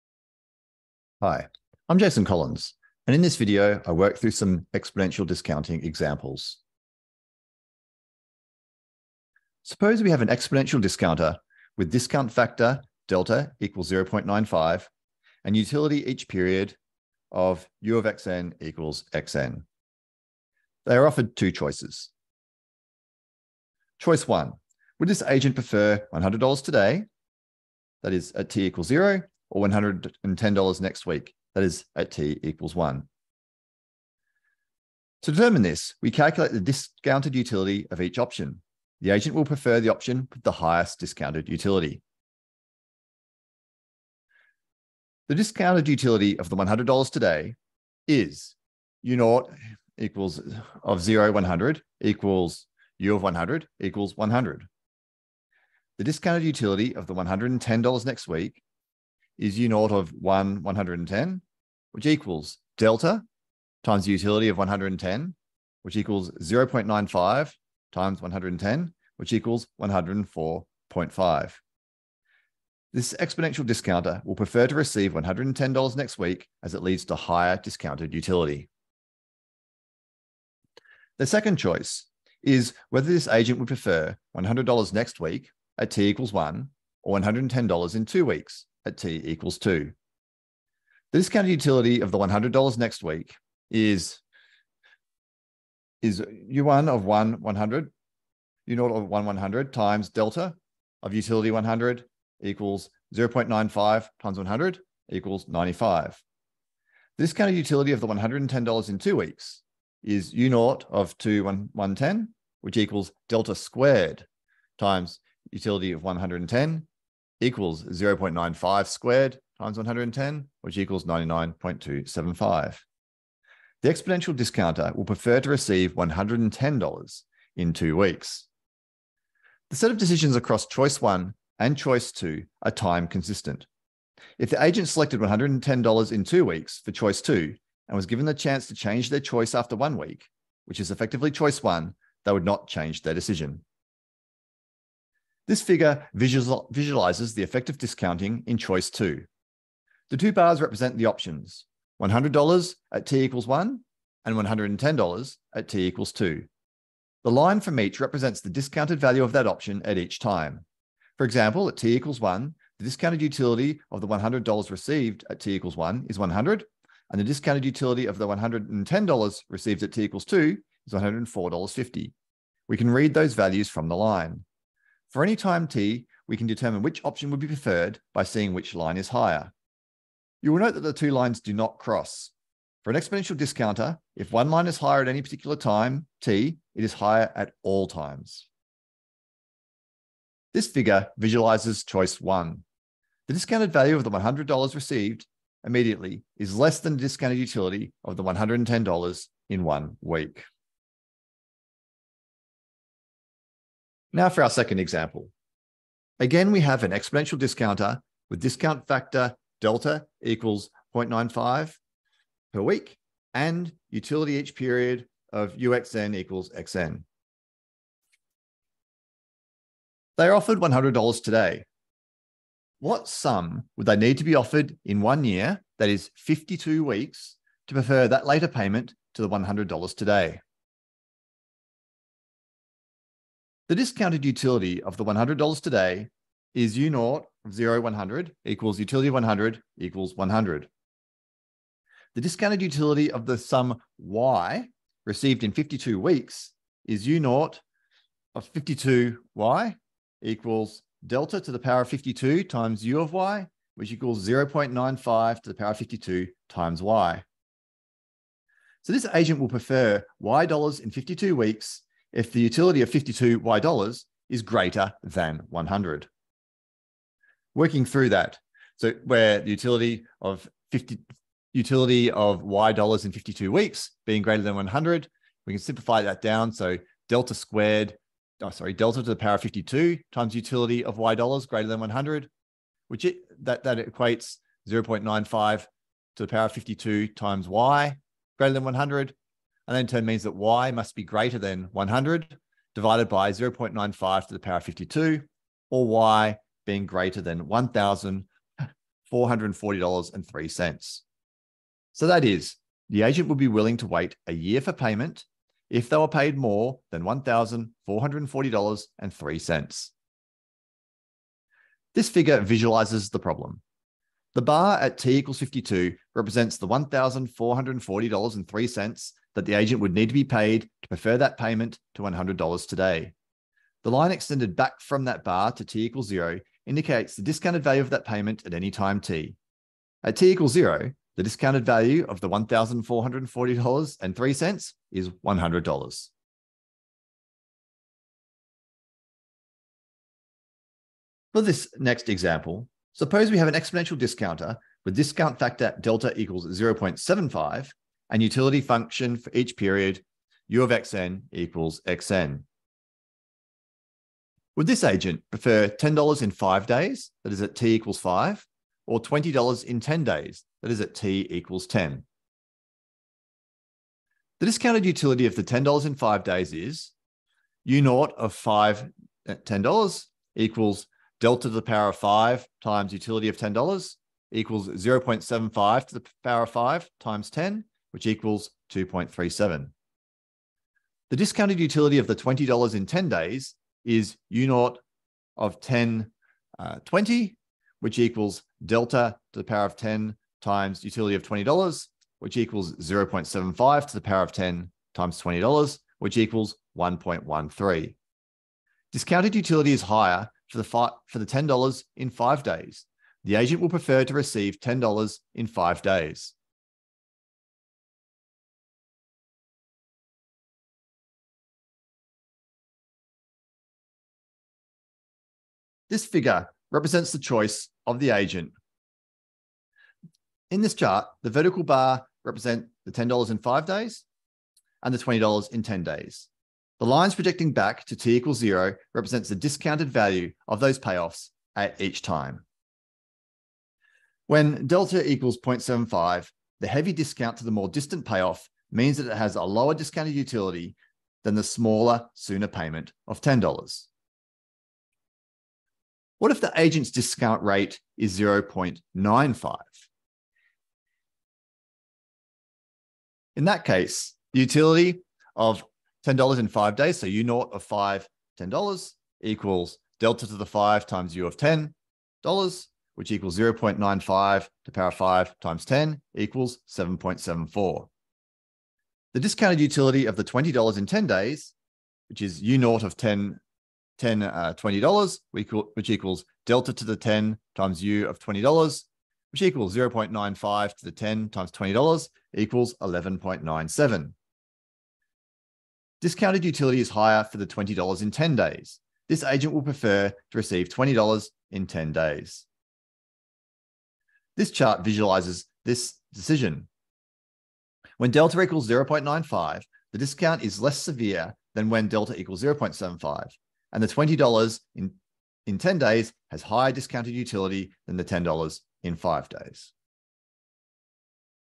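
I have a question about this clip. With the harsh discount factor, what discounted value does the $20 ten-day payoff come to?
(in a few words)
1.13.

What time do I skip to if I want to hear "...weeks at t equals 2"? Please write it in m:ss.
1:28.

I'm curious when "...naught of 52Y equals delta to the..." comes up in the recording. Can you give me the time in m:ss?
4:07.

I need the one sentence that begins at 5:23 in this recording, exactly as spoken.
The line extended back from that bar to t equals zero indicates the discounted value of that payment at any time t.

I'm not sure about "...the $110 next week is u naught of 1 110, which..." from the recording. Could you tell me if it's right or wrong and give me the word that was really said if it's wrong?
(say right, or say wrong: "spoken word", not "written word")
right.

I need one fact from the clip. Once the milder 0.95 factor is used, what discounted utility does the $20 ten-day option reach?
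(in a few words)
11.97.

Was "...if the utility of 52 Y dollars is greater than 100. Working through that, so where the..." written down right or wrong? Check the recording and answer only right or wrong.
right.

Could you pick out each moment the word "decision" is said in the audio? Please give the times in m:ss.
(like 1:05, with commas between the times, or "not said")
2:09, 2:23, 8:16.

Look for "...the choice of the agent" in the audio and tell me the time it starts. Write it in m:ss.
6:57.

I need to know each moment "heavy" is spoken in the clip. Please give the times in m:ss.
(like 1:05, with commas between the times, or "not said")
7:16.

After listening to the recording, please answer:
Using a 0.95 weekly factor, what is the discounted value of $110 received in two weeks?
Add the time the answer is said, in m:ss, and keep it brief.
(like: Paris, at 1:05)
99.275, at 2:01.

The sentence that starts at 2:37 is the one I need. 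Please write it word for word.
The line from each represents the discounted value of that option at each time.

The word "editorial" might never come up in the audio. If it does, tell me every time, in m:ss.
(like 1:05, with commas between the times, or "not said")
not said.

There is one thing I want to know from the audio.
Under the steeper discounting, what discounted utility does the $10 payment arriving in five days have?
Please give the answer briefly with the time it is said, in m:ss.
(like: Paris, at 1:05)
2.37, at 6:18.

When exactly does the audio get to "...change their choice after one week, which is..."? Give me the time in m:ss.
2:18.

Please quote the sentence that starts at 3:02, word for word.
For an exponential discounter, if one line is higher at any particular time, t, it is higher at all times.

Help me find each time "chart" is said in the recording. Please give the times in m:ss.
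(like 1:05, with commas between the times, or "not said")
7:00, 8:14.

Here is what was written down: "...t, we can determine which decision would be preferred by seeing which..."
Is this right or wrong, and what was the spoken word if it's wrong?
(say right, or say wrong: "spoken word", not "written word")
wrong: "option", not "decision".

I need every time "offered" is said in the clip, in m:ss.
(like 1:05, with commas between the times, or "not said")
0:21, 3:40, 3:44.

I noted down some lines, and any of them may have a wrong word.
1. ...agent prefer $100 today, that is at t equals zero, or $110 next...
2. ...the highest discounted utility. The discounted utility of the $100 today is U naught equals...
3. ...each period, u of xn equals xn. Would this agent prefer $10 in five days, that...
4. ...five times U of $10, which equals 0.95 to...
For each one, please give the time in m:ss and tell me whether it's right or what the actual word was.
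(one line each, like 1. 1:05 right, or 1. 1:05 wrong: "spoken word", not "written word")
1. 0:25 right
2. 0:40 right
3. 5:49 right
4. 7:40 right.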